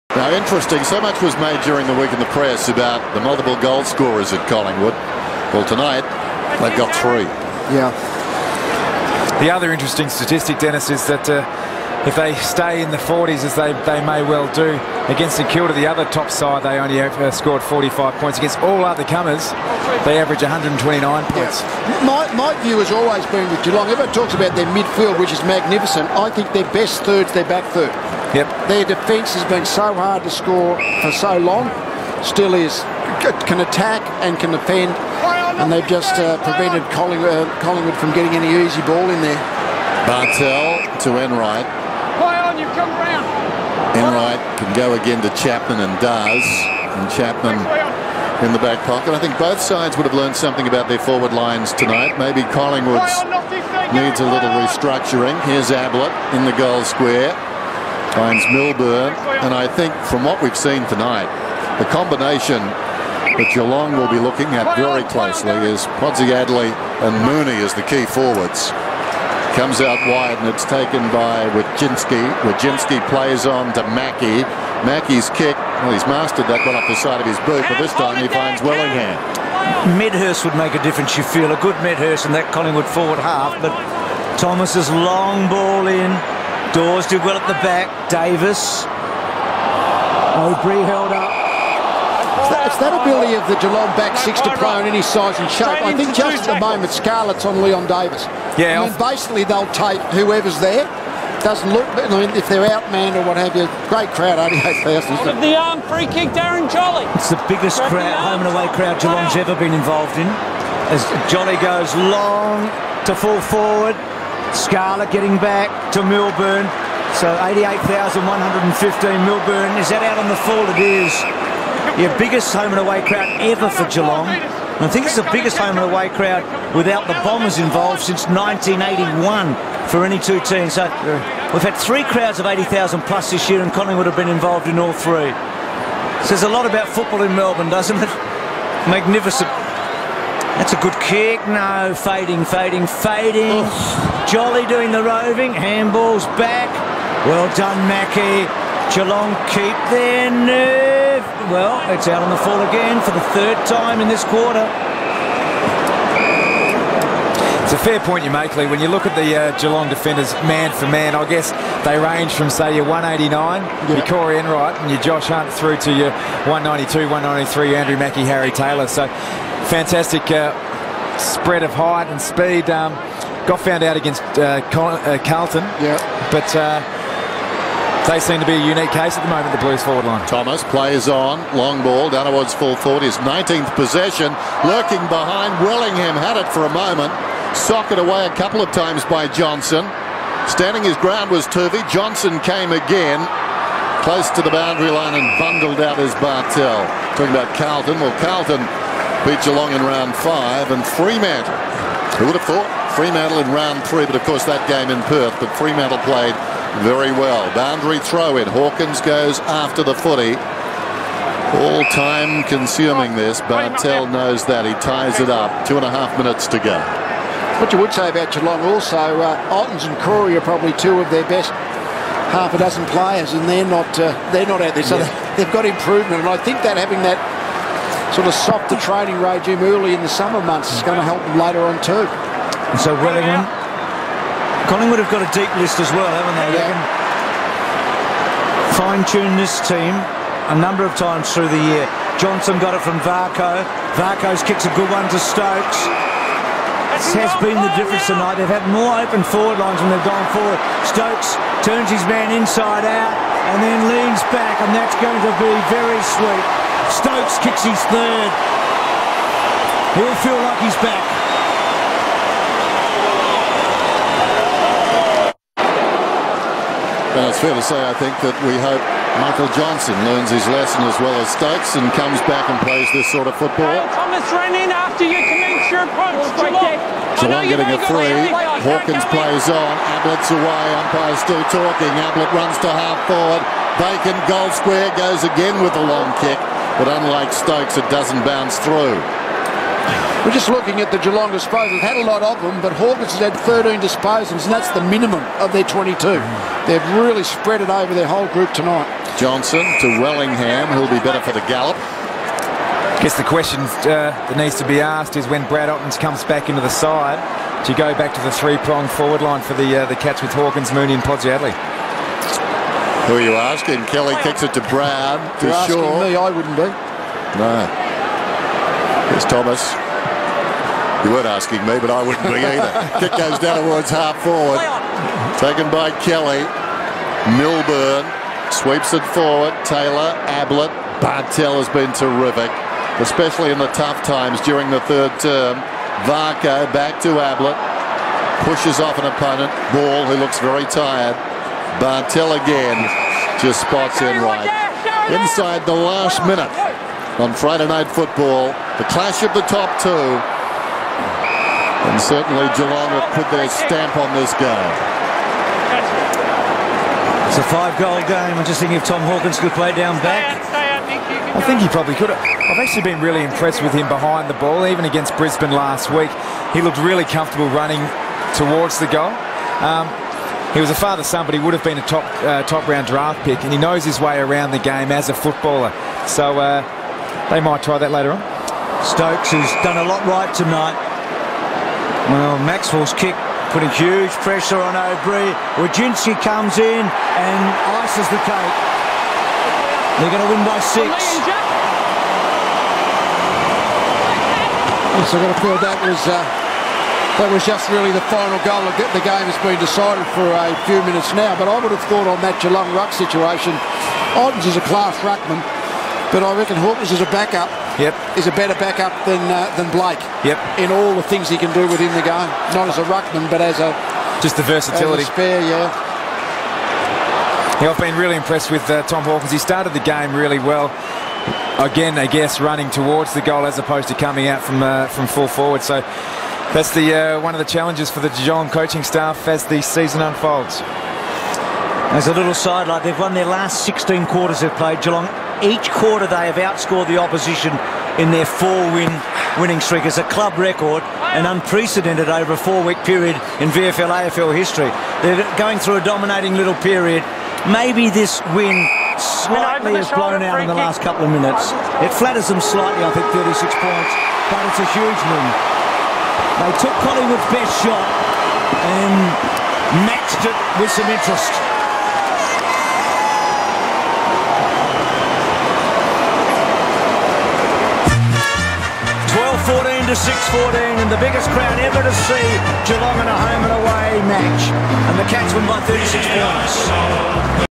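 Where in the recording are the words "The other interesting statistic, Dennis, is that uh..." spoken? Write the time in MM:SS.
00:09.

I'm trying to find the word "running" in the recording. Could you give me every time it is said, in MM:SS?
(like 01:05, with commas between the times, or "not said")
06:07, 07:02.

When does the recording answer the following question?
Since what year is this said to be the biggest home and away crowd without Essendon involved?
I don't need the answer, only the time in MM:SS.
02:08.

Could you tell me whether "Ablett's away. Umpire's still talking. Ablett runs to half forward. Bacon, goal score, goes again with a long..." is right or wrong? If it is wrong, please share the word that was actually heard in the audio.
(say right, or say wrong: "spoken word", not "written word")
wrong: "square", not "score".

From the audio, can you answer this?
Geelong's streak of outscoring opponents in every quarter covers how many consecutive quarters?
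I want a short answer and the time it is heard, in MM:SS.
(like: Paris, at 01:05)
16, at 07:13.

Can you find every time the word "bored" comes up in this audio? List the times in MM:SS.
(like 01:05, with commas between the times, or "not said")
not said.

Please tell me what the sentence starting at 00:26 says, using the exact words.
I think their best third's their back third.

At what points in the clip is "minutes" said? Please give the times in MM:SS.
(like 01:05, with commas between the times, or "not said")
03:36, 05:46, 06:40, 07:31.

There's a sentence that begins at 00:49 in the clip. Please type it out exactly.
I think both sides would have learned something about their forward lines tonight.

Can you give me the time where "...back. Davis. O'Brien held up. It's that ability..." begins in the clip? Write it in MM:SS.
01:27.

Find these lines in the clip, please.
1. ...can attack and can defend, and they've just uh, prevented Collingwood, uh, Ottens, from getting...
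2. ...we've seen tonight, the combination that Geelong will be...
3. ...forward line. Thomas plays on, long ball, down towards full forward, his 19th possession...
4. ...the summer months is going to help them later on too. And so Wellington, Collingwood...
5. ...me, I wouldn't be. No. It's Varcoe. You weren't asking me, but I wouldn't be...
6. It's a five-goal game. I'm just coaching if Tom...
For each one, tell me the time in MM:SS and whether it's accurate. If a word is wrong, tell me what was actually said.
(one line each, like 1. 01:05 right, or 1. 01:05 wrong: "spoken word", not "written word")
1. 00:33 wrong: "Collingwood", not "Ottens"
2. 01:00 right
3. 02:59 right
4. 03:50 right
5. 05:16 wrong: "Thomas", not "Varcoe"
6. 05:57 wrong: "thinking", not "coaching".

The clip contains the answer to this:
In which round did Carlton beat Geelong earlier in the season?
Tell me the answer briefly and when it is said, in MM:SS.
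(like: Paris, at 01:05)
Round 5, at 03:19.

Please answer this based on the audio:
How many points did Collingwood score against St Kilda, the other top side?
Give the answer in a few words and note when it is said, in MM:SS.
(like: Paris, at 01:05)
45, at 00:17.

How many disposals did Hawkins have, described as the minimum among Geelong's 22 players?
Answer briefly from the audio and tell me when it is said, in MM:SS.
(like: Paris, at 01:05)
13, at 04:53.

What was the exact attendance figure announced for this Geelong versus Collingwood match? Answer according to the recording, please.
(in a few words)
88,115.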